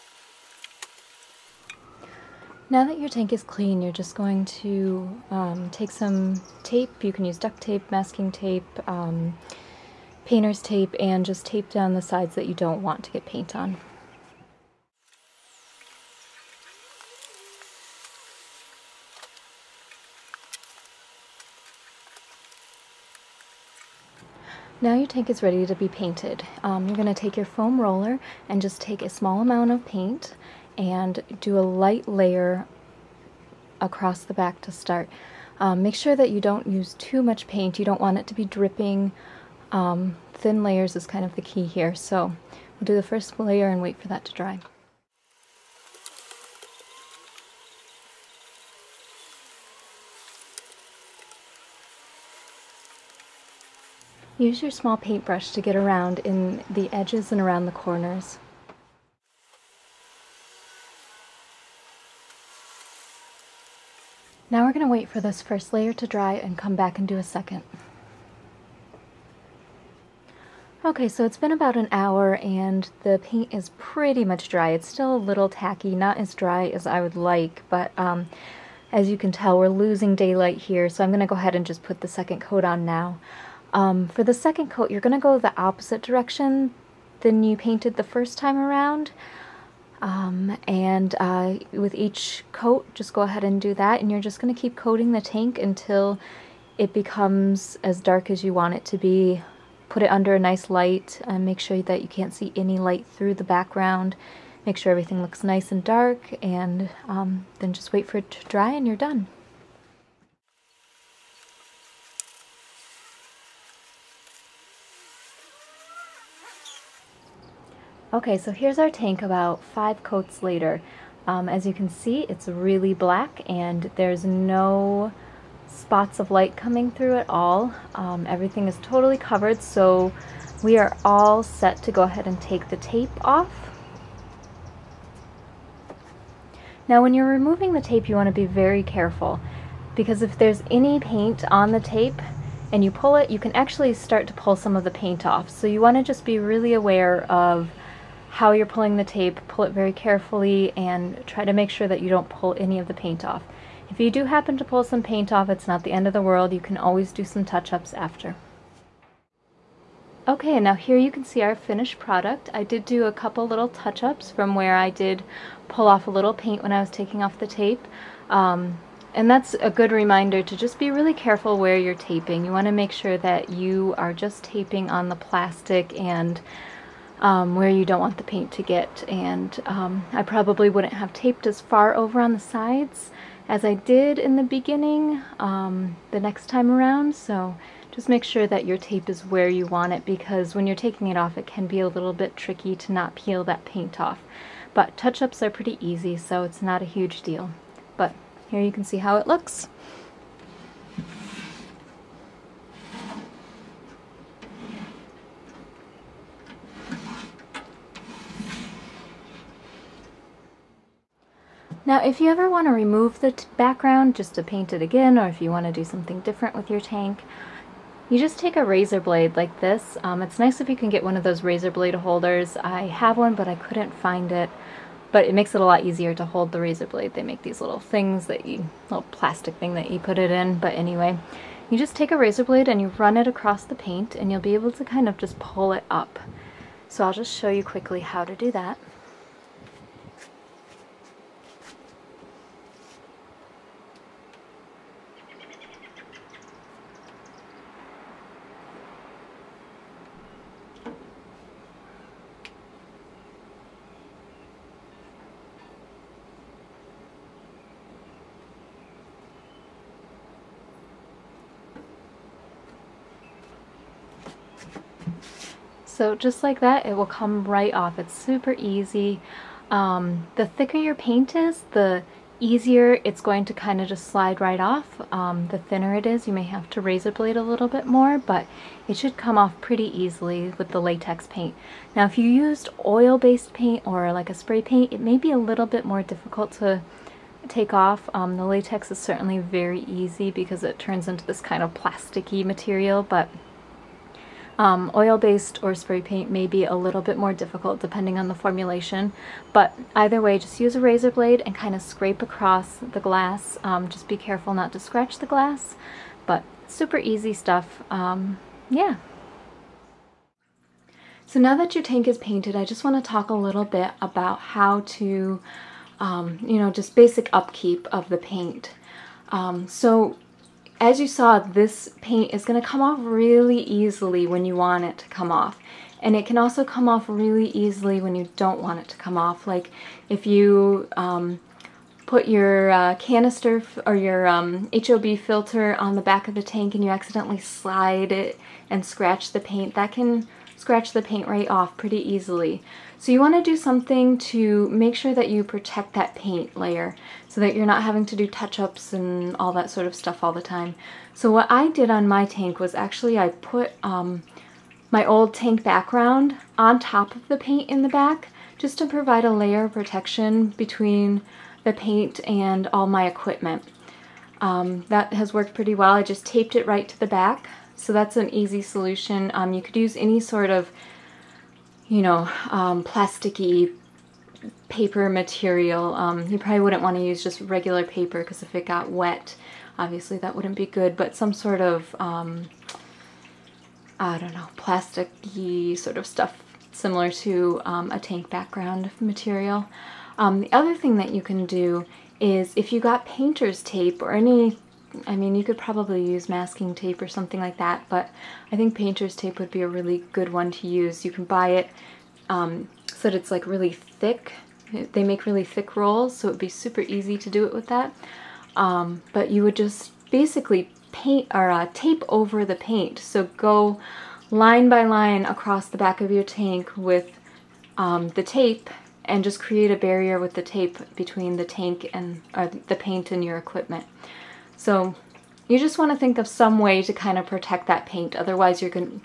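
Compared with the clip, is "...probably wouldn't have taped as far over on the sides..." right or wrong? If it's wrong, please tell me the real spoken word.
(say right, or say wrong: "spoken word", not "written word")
right.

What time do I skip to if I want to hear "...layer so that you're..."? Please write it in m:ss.
5:46.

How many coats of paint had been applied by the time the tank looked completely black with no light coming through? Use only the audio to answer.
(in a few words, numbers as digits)
5.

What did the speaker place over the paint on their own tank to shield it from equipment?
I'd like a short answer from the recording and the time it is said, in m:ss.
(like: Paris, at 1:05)
Old tank background, at 5:55.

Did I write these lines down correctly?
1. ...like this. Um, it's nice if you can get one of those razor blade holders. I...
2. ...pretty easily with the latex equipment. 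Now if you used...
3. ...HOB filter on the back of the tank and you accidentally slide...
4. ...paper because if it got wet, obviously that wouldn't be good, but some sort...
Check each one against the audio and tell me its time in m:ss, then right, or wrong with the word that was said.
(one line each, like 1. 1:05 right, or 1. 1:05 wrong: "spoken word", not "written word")
1. 3:39 right
2. 4:39 wrong: "paint", not "equipment"
3. 5:34 right
4. 6:17 right.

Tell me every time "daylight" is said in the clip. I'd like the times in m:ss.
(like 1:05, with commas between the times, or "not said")
1:20.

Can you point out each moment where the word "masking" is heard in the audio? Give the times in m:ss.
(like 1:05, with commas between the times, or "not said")
0:07, 6:36.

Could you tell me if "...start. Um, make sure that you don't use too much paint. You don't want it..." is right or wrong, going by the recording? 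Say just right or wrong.
right.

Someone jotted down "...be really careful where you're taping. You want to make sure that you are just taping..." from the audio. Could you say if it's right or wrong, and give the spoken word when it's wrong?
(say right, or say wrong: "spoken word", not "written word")
right.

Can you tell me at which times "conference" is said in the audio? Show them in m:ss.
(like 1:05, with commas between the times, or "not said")
not said.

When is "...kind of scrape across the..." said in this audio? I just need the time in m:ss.
5:01.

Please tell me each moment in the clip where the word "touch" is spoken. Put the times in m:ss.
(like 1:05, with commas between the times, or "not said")
2:37, 2:43, 3:14, 5:48.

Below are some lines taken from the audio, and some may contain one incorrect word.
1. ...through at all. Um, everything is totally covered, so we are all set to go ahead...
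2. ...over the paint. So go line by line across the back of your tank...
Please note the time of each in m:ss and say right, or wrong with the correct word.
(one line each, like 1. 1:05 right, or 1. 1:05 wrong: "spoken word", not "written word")
1. 2:06 right
2. 6:52 right.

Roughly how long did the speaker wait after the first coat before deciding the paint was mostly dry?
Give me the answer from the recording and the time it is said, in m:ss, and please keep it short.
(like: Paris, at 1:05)
About an hour, at 1:11.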